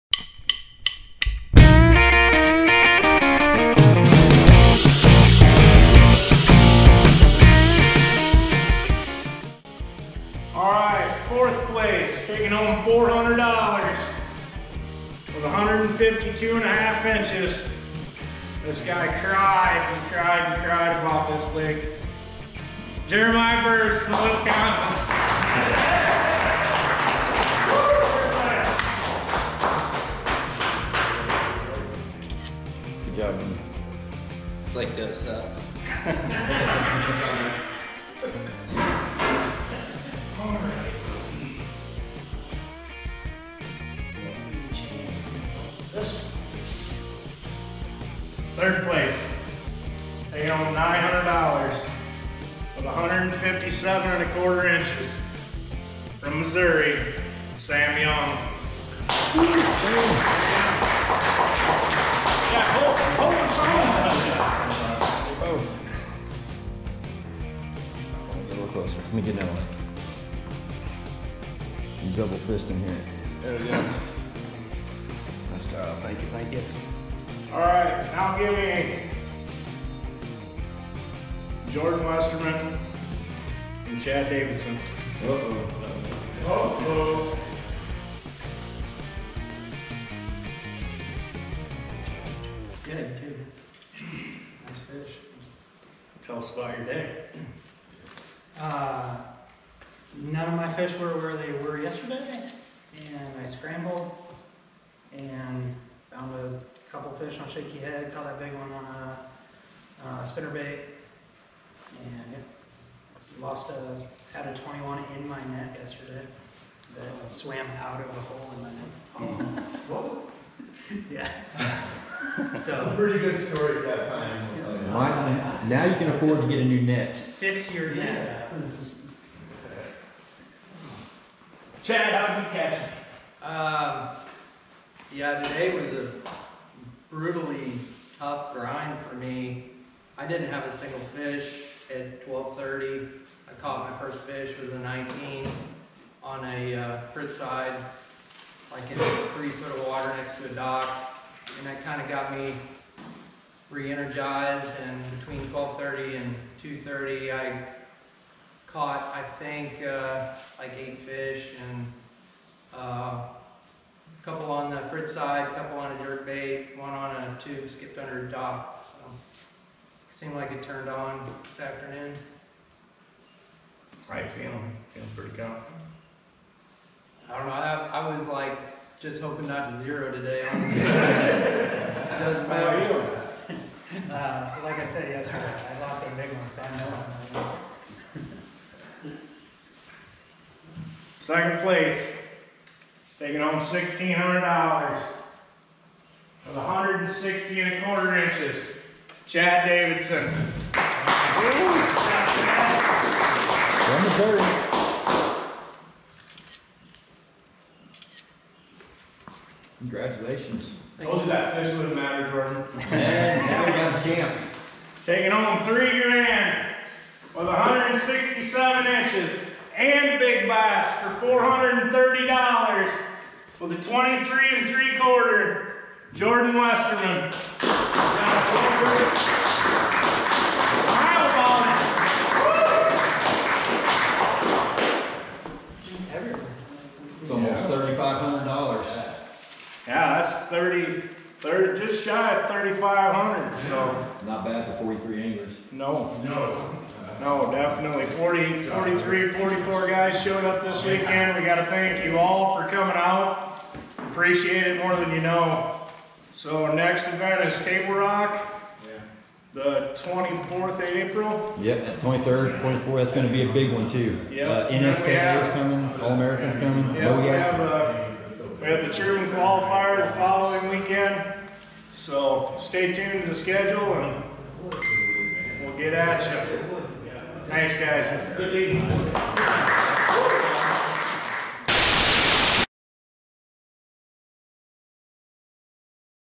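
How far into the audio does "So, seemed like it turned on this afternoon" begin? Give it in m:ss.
2:48.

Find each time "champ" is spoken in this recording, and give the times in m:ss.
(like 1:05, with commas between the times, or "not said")
3:34.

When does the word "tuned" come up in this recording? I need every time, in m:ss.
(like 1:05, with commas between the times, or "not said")
4:32.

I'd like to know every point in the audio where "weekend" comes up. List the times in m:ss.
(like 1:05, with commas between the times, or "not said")
4:10, 4:30.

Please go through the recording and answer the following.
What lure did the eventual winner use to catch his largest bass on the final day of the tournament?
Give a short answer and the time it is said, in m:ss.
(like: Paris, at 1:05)
spinnerbait, at 1:50.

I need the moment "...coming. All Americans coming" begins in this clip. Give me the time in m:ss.
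4:25.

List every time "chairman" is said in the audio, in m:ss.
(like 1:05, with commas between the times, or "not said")
4:28.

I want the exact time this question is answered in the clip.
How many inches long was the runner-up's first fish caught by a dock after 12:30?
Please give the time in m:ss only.
2:24.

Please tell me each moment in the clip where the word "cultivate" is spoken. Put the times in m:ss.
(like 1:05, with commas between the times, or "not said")
not said.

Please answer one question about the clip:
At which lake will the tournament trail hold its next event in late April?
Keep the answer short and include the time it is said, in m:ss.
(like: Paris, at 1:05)
Table Rock, at 4:17.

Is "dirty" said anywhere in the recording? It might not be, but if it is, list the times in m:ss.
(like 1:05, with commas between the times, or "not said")
not said.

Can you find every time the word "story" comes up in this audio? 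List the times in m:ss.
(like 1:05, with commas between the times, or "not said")
2:03.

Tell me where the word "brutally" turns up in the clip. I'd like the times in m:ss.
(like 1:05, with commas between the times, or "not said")
2:17.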